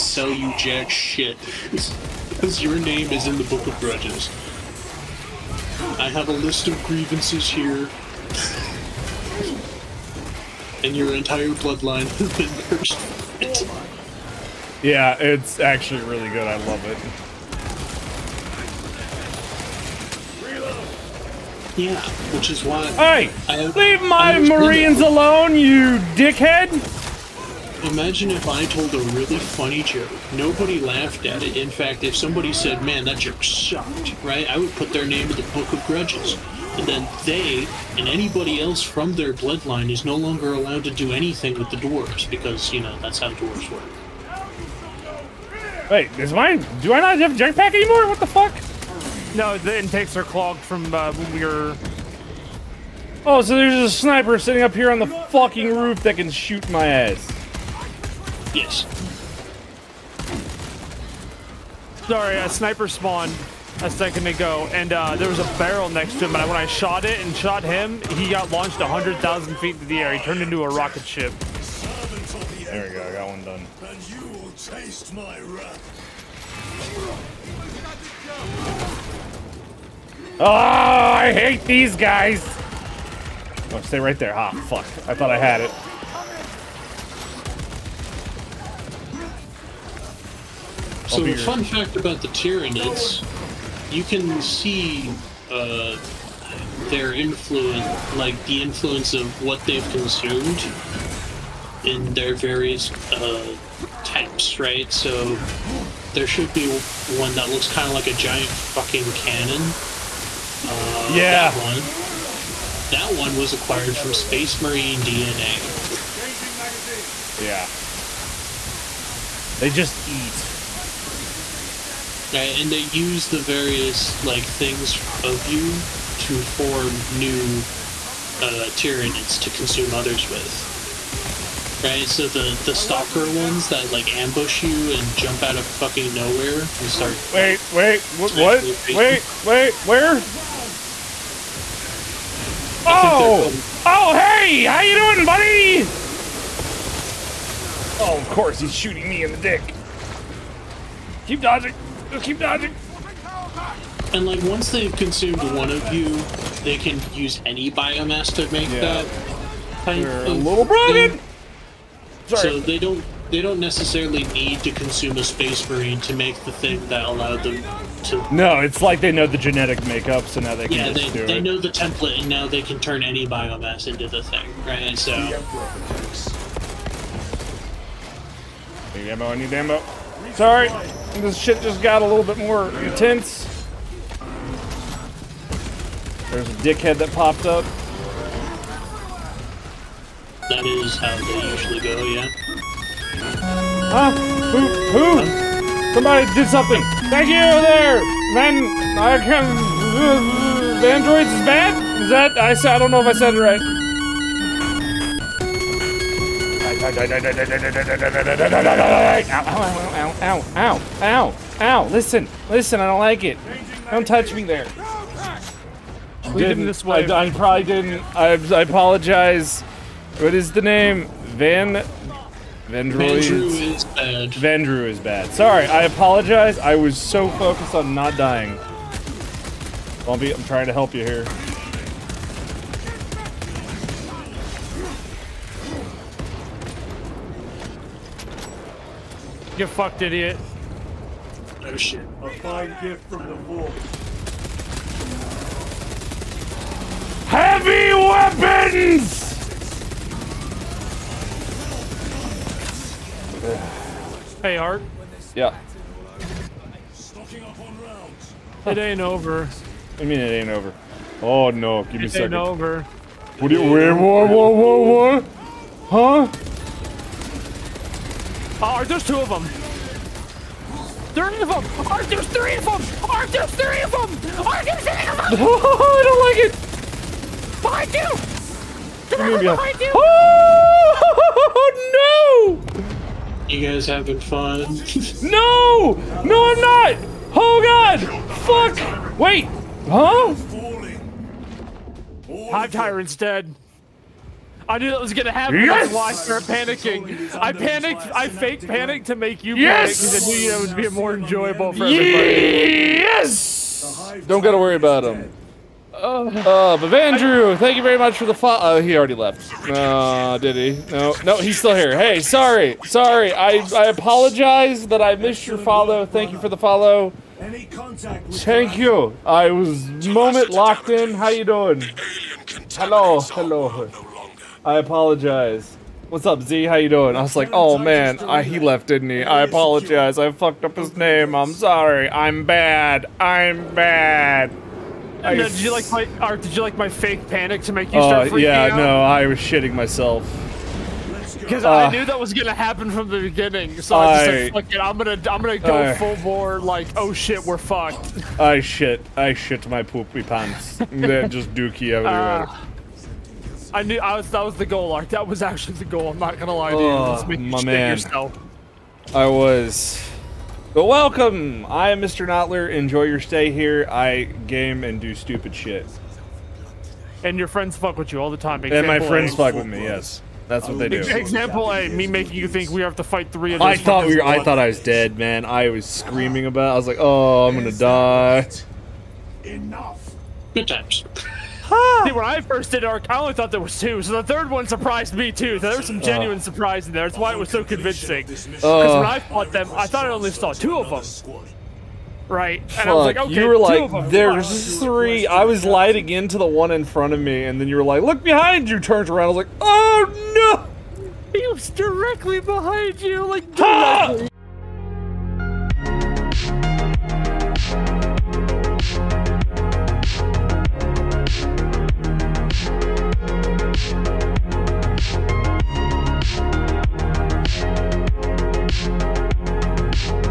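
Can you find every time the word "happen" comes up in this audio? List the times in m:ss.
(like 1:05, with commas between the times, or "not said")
4:55, 5:42.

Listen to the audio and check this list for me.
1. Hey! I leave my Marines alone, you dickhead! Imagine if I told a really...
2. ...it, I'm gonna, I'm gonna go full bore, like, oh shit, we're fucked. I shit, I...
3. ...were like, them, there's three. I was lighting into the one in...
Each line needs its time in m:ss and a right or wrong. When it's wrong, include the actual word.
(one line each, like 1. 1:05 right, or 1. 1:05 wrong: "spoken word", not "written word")
1. 0:22 right
2. 5:44 right
3. 6:33 right.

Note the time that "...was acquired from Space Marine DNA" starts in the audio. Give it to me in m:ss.
1:53.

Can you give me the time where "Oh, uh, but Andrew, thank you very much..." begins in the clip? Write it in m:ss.
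5:05.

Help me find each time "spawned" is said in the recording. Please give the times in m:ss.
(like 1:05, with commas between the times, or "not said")
1:02.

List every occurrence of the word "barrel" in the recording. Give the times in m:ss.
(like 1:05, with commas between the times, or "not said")
1:05.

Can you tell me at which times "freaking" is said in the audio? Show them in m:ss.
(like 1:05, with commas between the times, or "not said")
5:38.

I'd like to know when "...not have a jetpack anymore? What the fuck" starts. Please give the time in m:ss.
0:47.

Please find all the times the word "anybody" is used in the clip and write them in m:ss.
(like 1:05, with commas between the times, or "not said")
0:38.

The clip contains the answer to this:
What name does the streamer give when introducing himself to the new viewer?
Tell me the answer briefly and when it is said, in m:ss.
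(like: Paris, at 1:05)
Mr. Knotler, at 6:02.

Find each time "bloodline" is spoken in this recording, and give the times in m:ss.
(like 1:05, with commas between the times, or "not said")
0:11, 0:39.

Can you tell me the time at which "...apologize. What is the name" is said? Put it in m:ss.
3:38.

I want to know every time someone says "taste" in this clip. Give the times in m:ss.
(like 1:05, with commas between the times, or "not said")
1:14.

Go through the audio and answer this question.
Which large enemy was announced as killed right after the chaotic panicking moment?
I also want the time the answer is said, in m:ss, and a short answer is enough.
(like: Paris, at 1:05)
Hive Tyrant, at 4:52.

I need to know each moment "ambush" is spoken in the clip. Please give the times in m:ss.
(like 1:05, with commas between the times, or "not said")
2:14.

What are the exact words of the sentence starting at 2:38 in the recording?
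that kind are of a little bragging.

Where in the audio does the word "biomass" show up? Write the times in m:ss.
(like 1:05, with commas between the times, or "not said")
2:37, 2:53.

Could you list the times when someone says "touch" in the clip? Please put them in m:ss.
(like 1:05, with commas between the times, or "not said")
3:34.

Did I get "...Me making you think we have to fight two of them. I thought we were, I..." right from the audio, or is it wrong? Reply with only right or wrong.
wrong.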